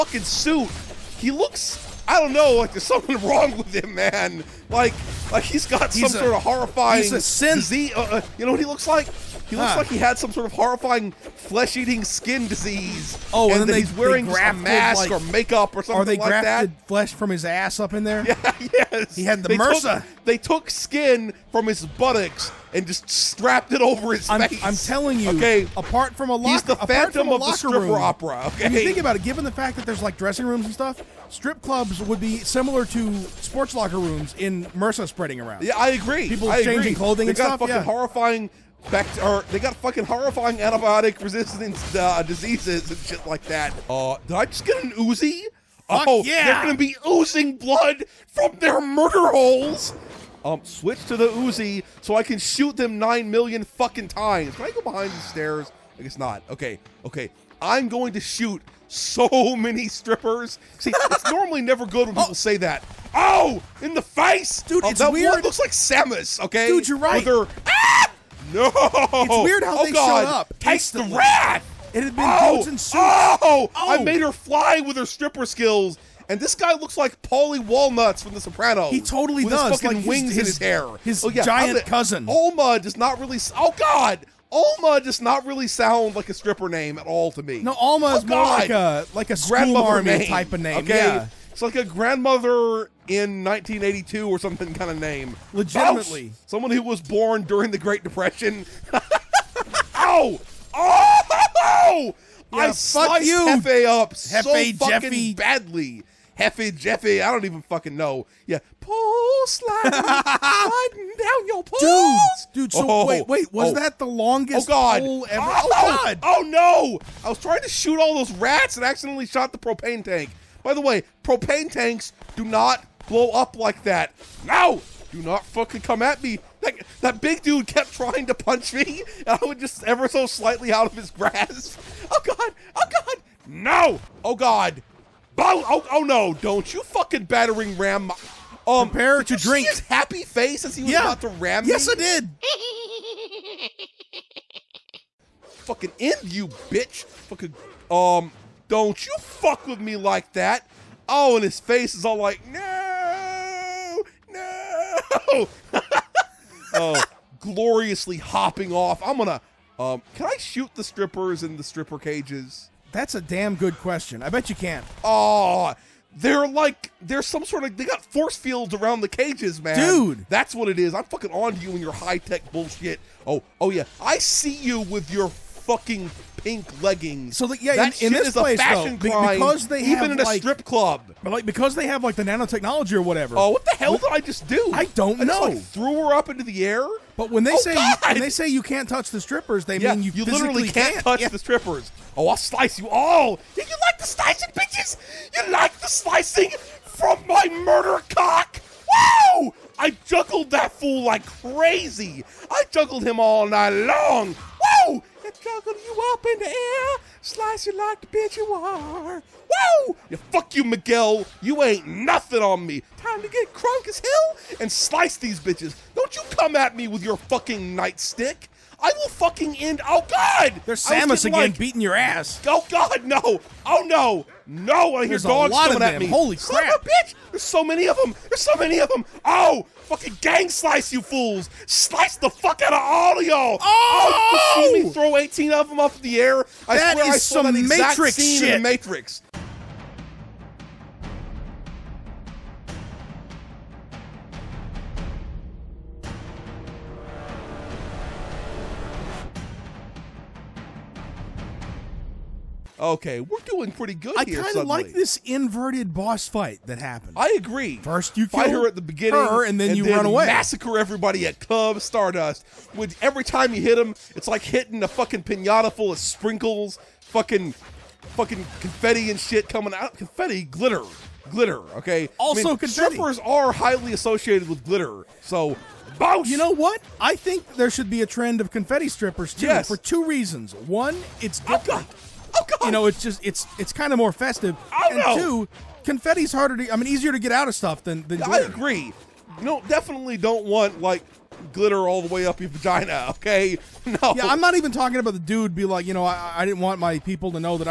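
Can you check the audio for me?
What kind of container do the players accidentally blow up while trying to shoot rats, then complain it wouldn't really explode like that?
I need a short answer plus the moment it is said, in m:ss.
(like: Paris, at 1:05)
Propane tank, at 1:59.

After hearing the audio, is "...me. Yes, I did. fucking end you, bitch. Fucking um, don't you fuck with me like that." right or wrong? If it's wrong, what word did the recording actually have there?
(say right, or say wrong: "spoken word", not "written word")
right.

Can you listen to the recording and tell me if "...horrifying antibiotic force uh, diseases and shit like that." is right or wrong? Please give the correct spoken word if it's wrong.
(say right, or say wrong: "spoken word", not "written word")
wrong: "resistance", not "force".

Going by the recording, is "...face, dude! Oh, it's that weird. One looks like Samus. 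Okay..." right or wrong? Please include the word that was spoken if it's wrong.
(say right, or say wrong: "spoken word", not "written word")
right.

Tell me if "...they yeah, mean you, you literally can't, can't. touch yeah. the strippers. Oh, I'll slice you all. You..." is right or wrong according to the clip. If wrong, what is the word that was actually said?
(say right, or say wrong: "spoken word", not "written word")
right.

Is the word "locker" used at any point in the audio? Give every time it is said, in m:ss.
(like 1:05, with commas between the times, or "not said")
0:26, 0:33.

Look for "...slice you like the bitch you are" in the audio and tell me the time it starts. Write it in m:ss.
3:27.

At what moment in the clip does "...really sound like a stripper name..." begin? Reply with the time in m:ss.
1:25.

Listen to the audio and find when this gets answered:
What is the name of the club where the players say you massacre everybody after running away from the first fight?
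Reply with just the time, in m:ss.
4:21.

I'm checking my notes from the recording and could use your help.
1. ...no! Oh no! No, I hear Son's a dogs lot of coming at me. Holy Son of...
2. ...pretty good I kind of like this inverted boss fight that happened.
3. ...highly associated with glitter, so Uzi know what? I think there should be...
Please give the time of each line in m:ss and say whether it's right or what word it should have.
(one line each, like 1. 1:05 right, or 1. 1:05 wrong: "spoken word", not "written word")
1. 3:43 wrong: "There", not "Son"
2. 4:13 right
3. 4:33 wrong: "You", not "Uzi".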